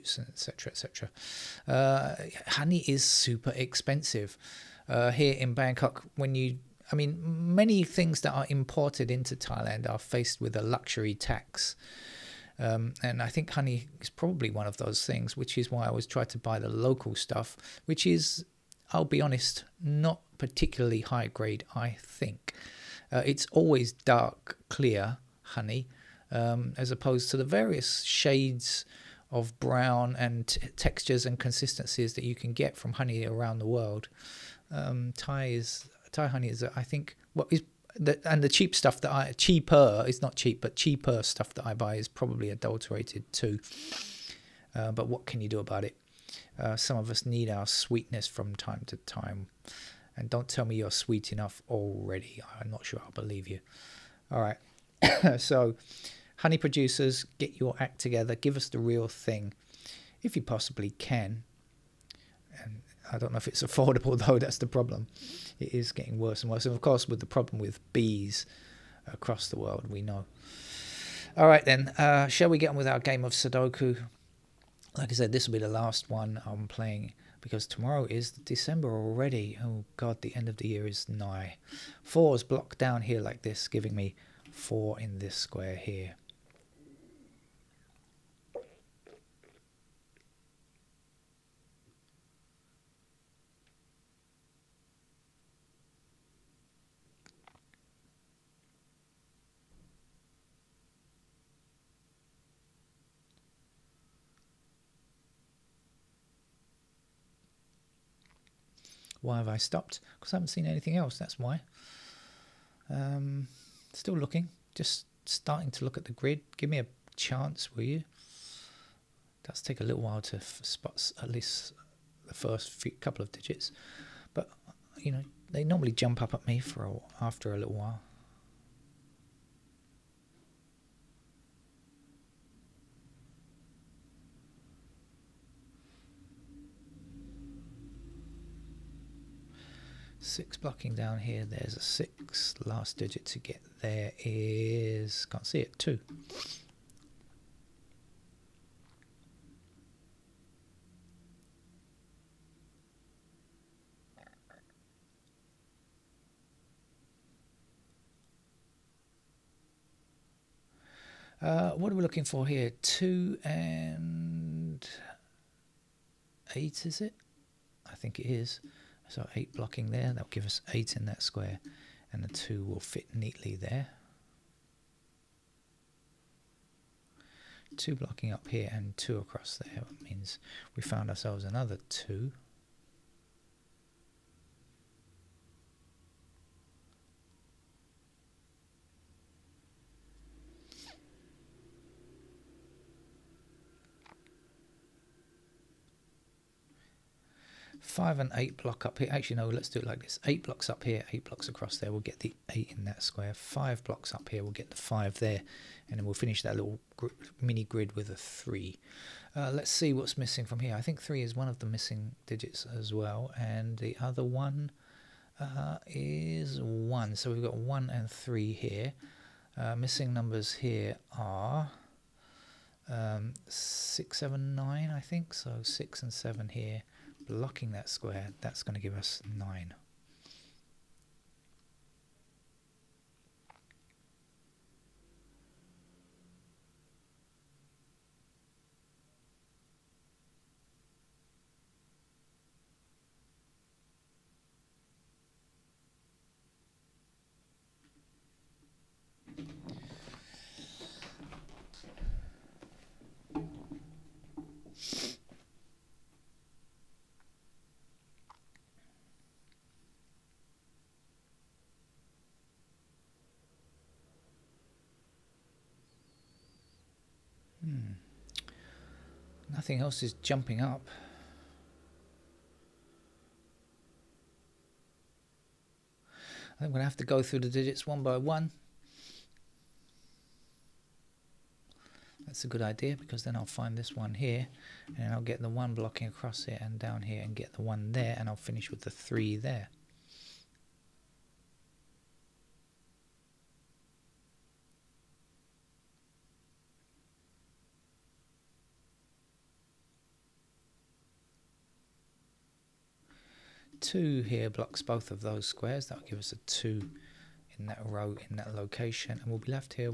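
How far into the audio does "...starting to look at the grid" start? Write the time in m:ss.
1:55.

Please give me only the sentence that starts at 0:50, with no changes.
And don't tell me you're sweet enough already.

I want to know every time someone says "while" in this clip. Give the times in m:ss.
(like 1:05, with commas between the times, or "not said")
2:00, 2:07.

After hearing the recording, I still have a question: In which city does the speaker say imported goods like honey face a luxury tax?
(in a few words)
Bangkok.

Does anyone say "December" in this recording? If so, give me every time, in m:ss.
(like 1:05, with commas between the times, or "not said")
1:18.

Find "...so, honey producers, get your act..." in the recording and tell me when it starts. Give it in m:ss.
0:55.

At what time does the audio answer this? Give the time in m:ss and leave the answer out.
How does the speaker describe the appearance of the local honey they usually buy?
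0:23.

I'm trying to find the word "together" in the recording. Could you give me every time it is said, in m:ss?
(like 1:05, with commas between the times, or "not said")
0:57.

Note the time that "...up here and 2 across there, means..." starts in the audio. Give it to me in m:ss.
2:58.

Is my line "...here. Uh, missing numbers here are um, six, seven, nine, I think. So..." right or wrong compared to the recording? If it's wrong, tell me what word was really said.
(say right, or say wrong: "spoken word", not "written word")
right.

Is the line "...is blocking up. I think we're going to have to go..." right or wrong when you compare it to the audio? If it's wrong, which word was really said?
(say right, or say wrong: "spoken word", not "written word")
wrong: "jumping", not "blocking".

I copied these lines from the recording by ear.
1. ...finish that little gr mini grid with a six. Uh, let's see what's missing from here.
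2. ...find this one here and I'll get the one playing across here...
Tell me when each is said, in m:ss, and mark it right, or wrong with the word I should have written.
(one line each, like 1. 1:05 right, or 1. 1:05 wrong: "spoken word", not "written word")
1. 3:26 wrong: "three", not "six"
2. 4:43 wrong: "blocking", not "playing".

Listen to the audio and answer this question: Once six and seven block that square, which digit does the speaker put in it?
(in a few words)
9.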